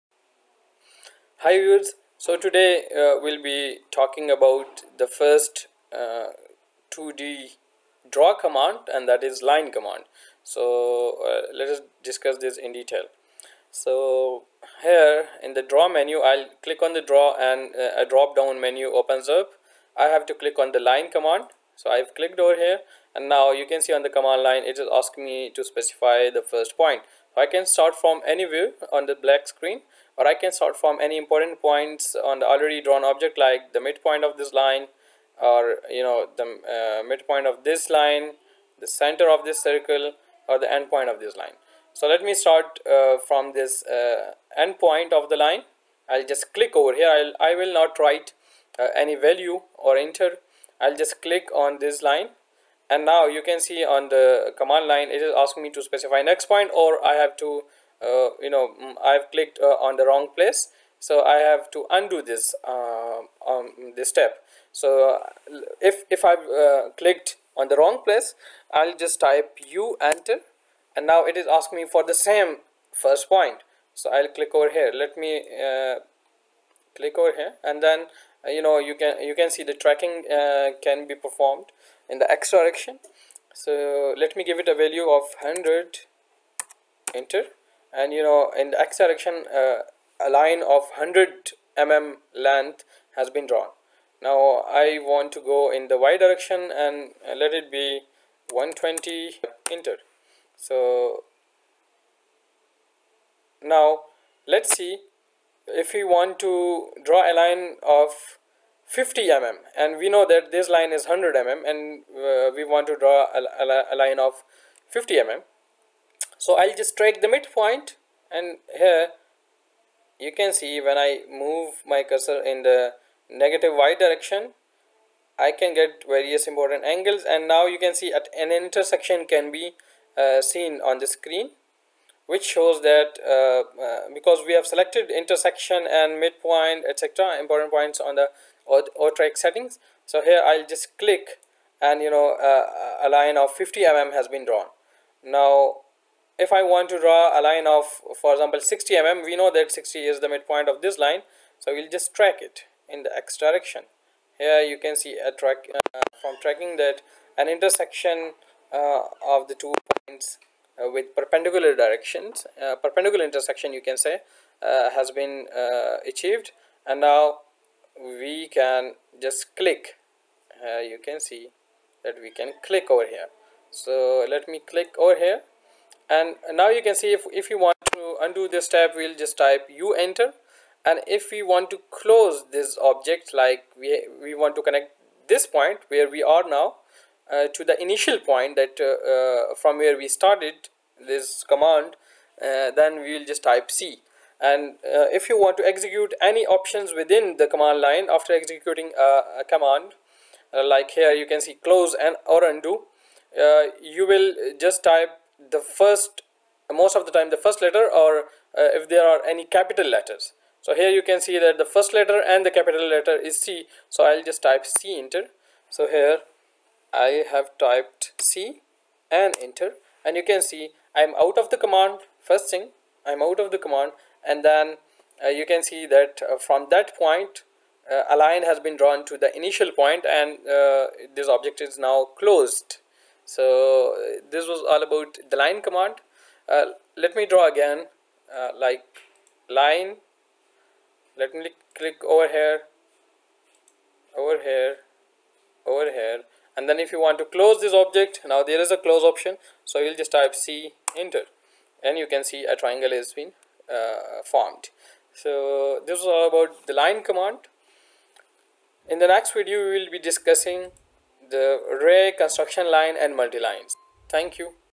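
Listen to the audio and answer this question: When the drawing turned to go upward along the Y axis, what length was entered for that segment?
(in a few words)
120.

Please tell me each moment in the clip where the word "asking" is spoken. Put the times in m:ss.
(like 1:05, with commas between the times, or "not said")
0:24, 0:55, 1:11.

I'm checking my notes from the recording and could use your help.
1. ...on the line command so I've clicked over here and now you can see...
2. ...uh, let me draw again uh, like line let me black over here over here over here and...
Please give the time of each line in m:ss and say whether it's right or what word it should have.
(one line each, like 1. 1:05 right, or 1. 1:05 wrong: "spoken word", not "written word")
1. 0:20 right
2. 3:56 wrong: "click", not "black".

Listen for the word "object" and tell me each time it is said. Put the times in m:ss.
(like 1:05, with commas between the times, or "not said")
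0:33, 3:02, 3:51, 4:07.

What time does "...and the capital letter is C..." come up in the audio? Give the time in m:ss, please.
3:32.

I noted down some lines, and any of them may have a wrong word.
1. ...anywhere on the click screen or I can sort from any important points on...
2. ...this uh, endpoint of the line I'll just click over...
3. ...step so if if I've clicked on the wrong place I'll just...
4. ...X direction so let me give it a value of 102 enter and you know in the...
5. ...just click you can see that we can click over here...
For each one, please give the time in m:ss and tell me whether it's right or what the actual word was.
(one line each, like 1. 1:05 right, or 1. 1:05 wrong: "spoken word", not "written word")
1. 0:28 wrong: "black", not "click"
2. 0:43 right
3. 1:04 right
4. 1:22 wrong: "100", not "102"
5. 2:49 right.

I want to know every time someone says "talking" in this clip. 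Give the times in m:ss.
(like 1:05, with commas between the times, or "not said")
0:03.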